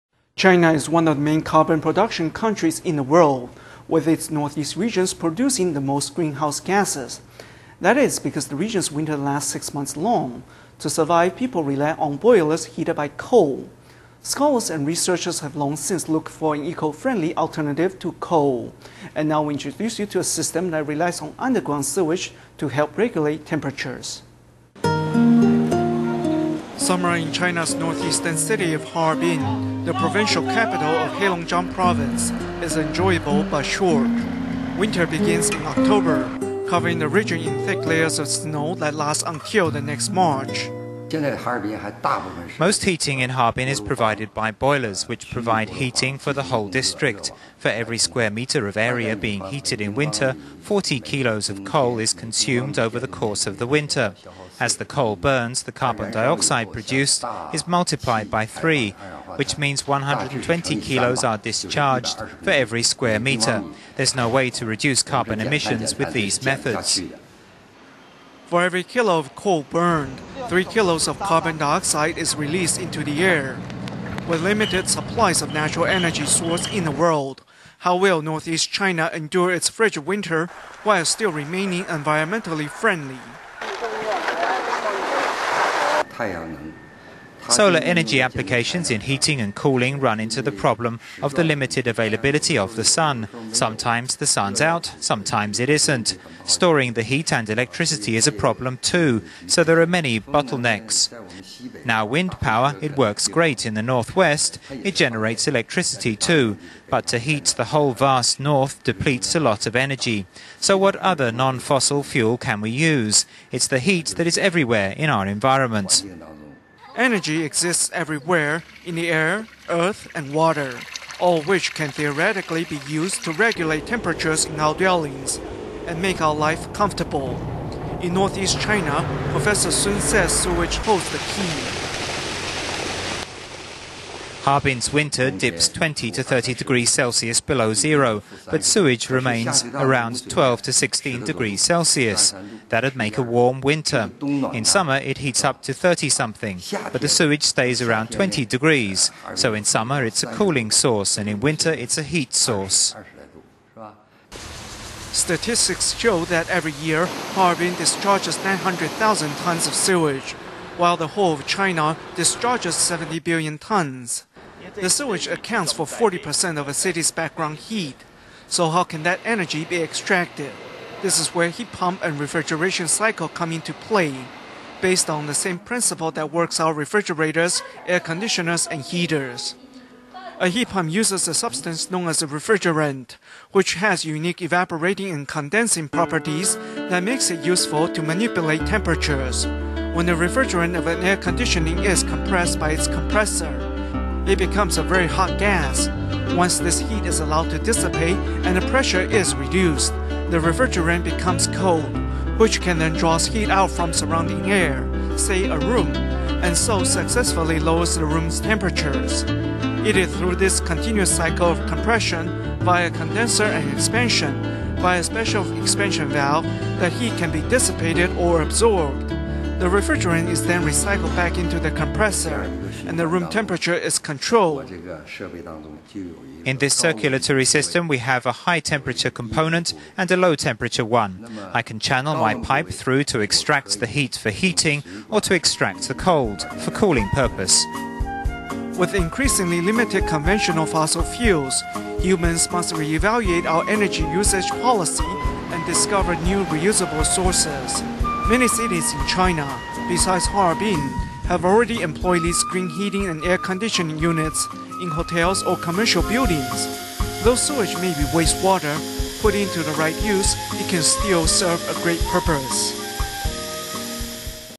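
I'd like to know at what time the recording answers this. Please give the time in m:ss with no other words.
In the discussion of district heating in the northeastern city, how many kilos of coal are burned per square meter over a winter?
0:50.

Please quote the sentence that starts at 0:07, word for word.
That is because the region's winter lasts six months long.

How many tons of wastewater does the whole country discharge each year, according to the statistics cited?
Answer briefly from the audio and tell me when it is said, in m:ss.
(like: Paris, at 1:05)
70 billion tons, at 2:42.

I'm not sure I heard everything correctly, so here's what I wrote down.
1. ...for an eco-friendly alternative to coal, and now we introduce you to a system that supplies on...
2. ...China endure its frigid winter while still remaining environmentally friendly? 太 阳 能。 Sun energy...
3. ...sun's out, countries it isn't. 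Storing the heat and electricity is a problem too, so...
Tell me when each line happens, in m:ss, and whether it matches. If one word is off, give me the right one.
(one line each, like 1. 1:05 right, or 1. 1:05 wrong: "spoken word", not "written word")
1. 0:16 wrong: "relies", not "supplies"
2. 1:18 wrong: "Solar", not "Sun"
3. 1:34 wrong: "sometimes", not "countries".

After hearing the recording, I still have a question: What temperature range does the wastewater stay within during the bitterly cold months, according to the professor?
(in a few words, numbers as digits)
12 to 16 degrees Celsius.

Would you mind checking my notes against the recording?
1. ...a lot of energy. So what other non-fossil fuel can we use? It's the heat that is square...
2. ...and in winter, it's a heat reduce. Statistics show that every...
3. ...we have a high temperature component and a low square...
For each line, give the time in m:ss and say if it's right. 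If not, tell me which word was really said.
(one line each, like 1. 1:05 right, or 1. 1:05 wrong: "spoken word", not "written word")
1. 1:49 wrong: "everywhere", not "square"
2. 2:31 wrong: "source", not "reduce"
3. 3:47 wrong: "temperature", not "square".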